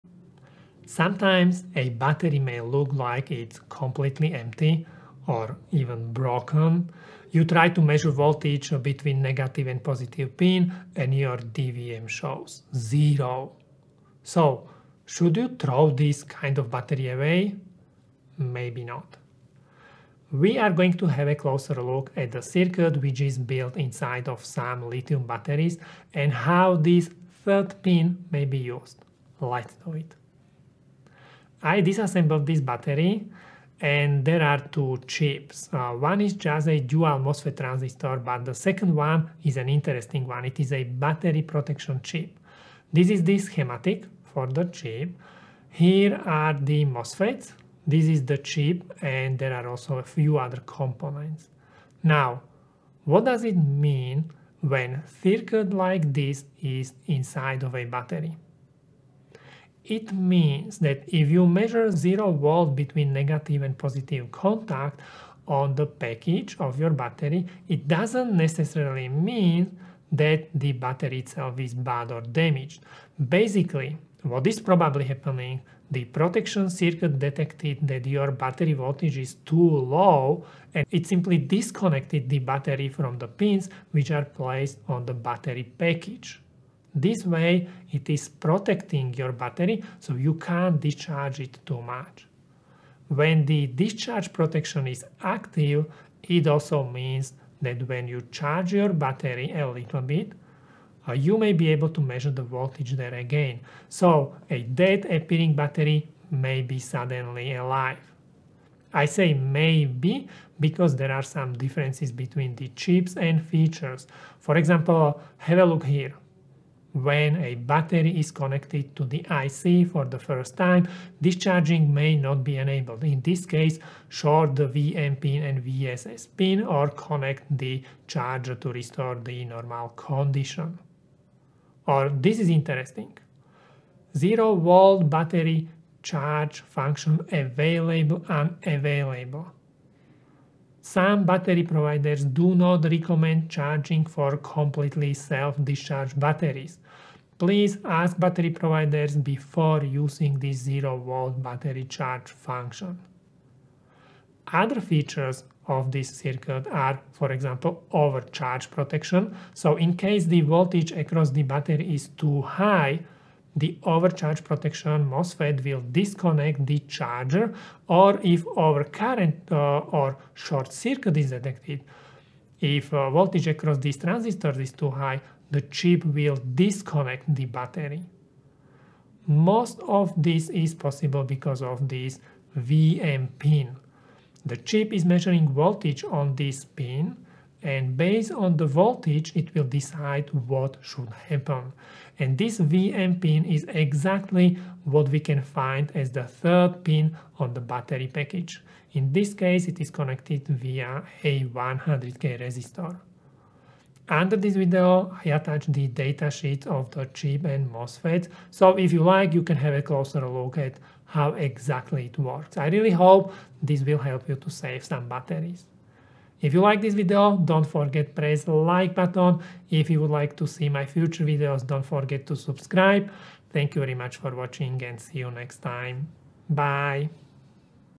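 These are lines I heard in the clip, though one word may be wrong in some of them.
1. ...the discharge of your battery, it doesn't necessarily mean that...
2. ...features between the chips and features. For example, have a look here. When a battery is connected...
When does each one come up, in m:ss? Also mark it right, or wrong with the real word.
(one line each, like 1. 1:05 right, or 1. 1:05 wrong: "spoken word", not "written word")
1. 1:05 wrong: "package", not "discharge"
2. 1:51 wrong: "differences", not "features".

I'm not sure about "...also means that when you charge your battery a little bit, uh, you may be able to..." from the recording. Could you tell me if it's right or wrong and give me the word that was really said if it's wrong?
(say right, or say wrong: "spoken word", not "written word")
right.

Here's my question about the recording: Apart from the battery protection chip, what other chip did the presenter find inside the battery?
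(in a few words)
Dual MOSFET transistor.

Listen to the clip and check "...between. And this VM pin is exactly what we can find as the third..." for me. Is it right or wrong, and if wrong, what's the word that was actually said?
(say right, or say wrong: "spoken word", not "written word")
wrong: "happen", not "between".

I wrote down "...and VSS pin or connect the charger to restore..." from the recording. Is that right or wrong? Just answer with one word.
right.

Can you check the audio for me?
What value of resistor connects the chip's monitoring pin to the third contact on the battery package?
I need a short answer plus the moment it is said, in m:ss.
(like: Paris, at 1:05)
100k, at 3:21.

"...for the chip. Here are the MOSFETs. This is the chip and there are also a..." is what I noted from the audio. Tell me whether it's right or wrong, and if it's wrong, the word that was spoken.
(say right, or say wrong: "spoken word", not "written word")
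right.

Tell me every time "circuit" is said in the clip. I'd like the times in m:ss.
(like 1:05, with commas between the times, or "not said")
0:22, 0:55, 1:16, 2:36, 2:50.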